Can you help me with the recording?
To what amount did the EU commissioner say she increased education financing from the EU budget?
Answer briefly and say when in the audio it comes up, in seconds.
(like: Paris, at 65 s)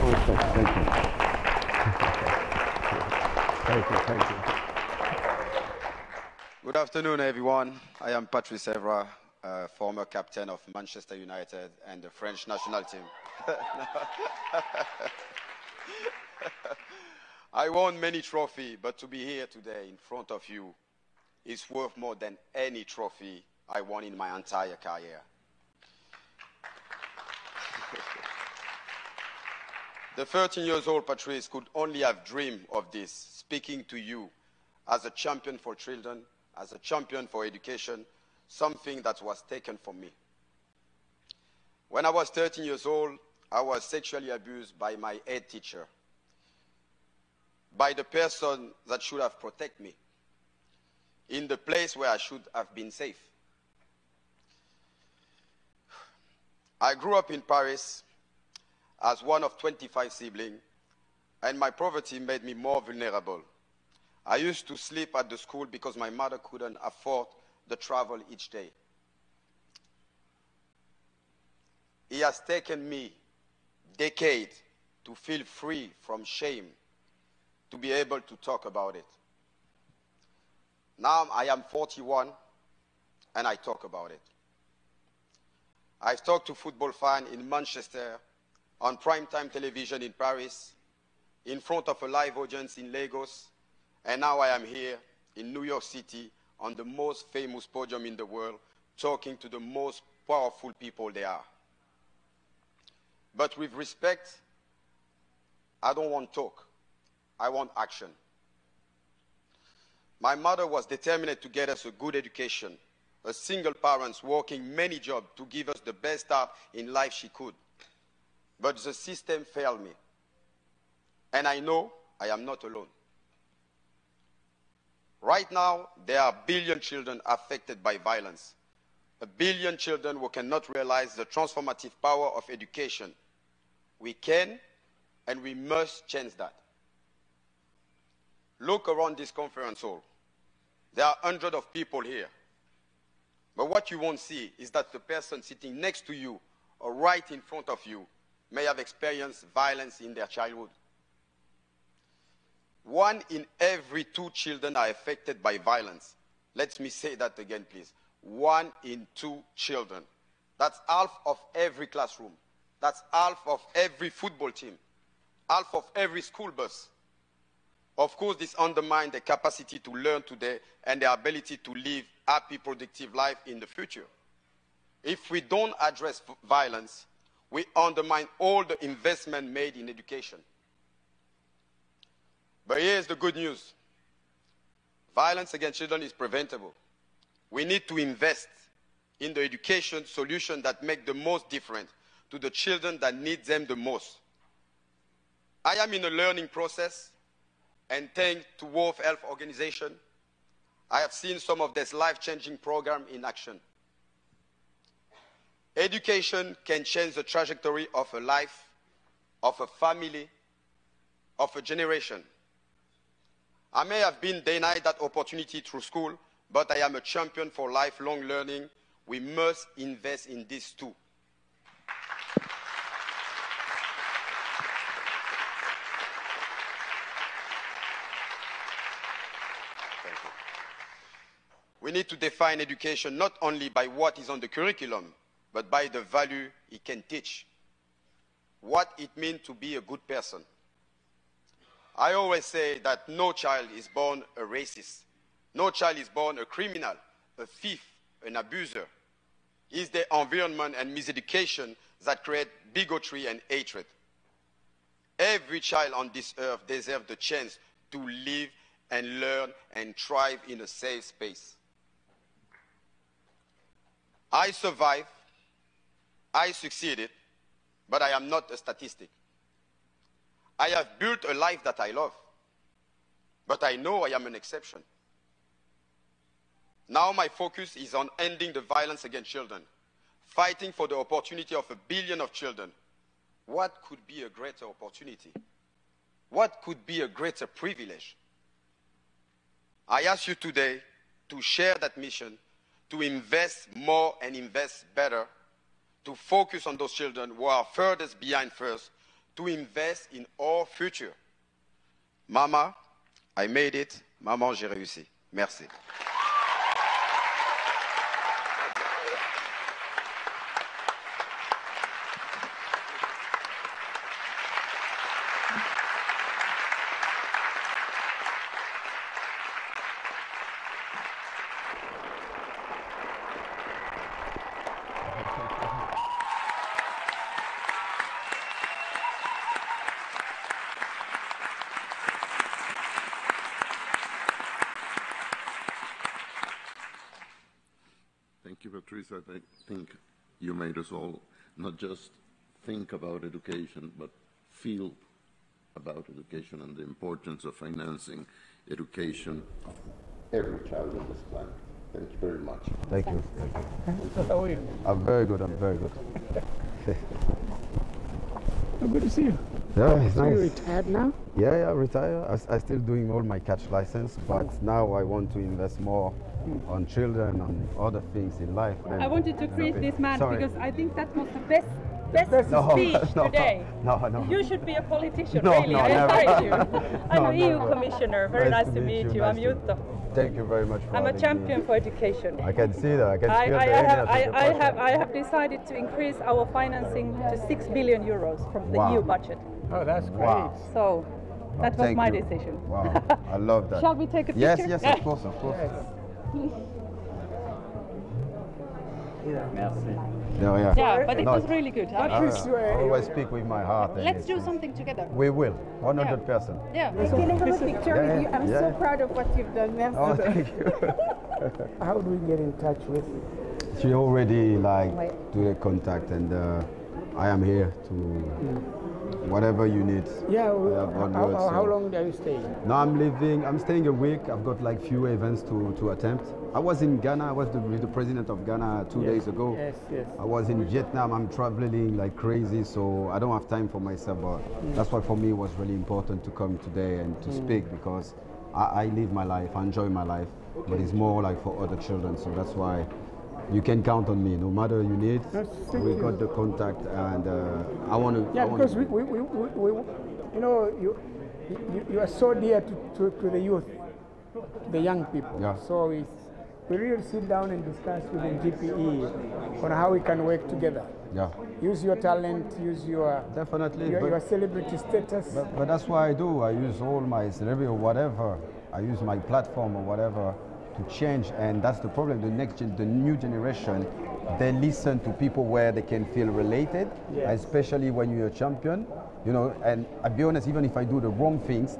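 6 billion euros, at 387 s.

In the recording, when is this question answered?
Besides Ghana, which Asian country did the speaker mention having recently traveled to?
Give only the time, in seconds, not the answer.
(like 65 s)
430 s.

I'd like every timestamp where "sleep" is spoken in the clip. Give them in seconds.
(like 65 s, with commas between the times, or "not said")
64 s.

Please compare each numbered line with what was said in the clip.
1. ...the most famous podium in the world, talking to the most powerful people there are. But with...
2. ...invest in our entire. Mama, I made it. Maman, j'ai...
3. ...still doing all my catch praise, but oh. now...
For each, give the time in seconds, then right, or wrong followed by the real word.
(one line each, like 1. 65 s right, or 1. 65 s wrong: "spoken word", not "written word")
1. 96 s right
2. 299 s wrong: "future", not "entire"
3. 362 s wrong: "license", not "praise".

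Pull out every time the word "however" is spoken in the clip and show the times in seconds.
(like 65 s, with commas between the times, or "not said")
not said.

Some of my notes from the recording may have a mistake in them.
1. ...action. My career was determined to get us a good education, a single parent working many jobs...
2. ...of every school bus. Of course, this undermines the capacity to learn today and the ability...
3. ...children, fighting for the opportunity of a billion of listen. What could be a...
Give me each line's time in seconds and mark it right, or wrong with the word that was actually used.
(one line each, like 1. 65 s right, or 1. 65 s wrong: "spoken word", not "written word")
1. 107 s wrong: "mother", not "career"
2. 165 s right
3. 279 s wrong: "children", not "listen".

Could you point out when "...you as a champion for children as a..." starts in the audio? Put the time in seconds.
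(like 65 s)
33 s.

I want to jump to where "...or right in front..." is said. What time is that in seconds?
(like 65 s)
146 s.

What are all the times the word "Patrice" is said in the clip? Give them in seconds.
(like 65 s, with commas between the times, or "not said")
8 s, 31 s.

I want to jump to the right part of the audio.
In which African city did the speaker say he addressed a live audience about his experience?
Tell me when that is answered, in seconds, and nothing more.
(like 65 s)
92 s.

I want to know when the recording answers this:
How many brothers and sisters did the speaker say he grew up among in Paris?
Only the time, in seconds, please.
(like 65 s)
59 s.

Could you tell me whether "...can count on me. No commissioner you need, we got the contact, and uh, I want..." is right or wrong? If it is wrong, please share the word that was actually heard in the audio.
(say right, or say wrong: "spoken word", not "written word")
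wrong: "matter", not "commissioner".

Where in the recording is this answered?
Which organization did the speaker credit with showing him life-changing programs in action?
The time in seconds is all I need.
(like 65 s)
198 s.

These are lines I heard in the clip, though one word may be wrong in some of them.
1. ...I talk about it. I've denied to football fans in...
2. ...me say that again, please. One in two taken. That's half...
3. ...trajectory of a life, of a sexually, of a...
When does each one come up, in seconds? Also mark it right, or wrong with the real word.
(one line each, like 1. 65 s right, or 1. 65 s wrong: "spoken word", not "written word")
1. 83 s wrong: "talked", not "denied"
2. 156 s wrong: "children", not "taken"
3. 207 s wrong: "family", not "sexually".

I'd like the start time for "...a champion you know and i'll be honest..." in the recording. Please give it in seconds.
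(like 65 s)
478 s.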